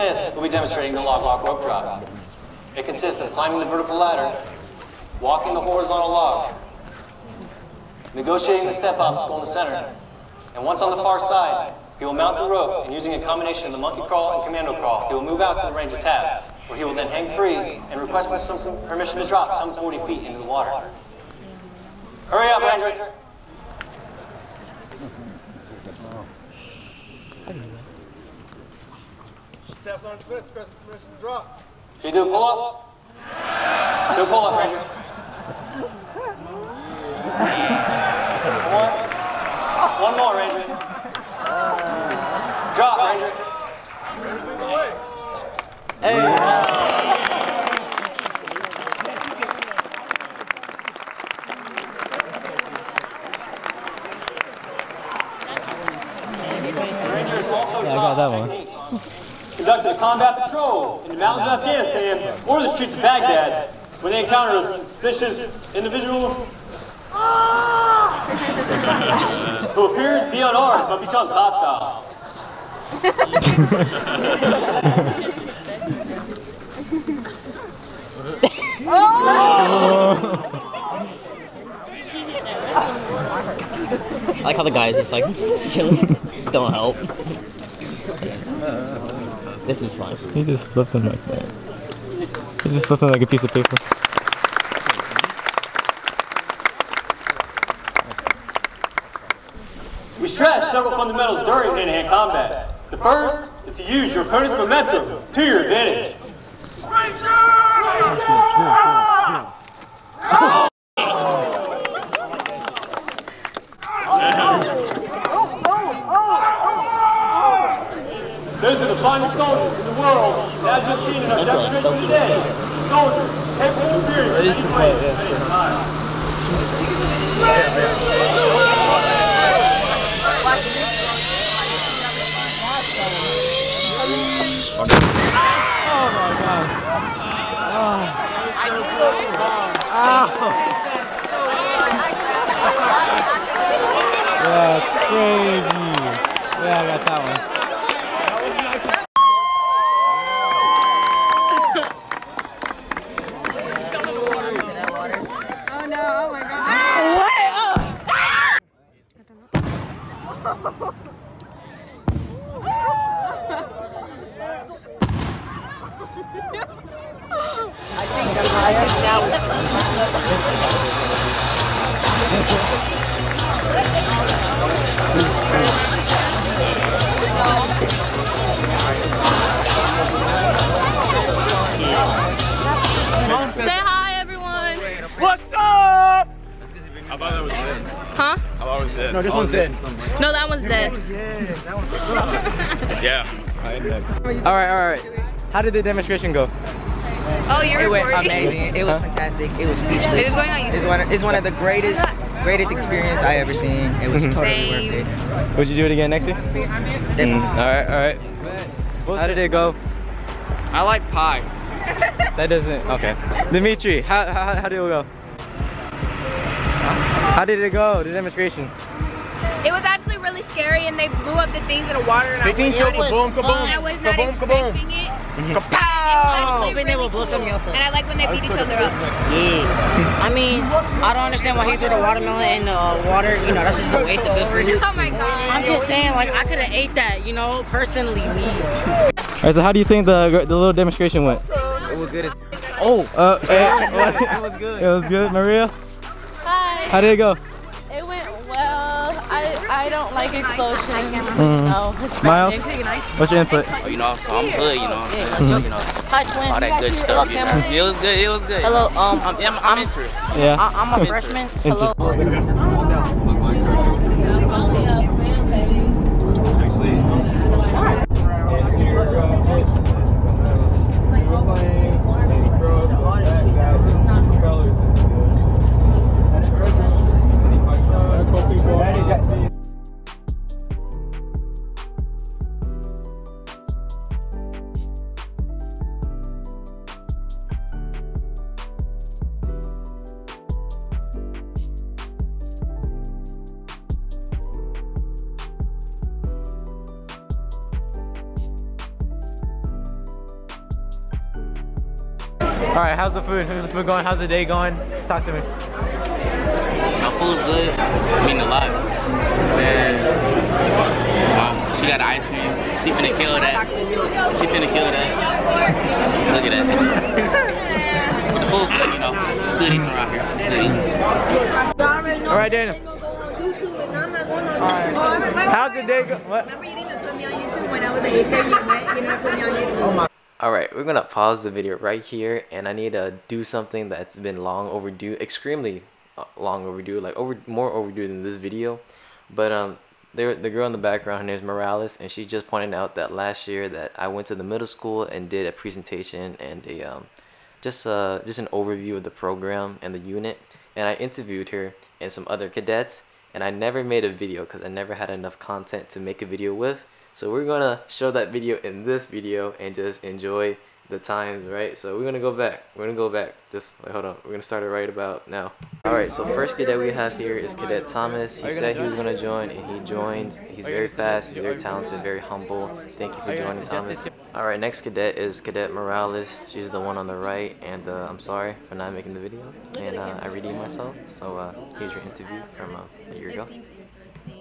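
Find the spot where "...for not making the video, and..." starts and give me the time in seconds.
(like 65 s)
378 s.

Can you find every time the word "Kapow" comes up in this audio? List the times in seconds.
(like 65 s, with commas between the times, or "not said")
225 s.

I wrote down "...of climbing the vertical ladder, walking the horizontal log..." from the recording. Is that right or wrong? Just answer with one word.
right.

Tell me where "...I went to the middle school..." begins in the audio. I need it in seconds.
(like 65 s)
343 s.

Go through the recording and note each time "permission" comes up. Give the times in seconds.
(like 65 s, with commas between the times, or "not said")
18 s, 30 s.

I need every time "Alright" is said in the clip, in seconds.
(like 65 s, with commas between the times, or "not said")
238 s.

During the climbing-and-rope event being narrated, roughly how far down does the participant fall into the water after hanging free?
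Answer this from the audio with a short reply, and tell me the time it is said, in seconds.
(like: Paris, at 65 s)
40 feet, at 19 s.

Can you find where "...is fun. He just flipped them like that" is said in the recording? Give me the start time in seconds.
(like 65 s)
89 s.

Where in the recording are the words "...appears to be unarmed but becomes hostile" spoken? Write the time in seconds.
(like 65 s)
69 s.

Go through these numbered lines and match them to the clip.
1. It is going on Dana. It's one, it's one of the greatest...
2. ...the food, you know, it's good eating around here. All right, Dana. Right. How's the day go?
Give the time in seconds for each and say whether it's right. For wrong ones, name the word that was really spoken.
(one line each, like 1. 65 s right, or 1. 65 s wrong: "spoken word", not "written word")
1. 200 s wrong: "YouTube", not "Dana"
2. 318 s right.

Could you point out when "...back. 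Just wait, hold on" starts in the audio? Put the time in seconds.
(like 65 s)
363 s.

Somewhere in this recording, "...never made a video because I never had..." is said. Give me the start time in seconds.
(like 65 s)
353 s.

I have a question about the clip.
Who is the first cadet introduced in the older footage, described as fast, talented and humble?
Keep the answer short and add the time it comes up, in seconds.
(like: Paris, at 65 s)
Cadet Thomas, at 367 s.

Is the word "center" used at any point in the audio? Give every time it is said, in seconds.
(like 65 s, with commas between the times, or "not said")
9 s.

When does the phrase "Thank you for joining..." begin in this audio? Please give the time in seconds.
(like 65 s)
372 s.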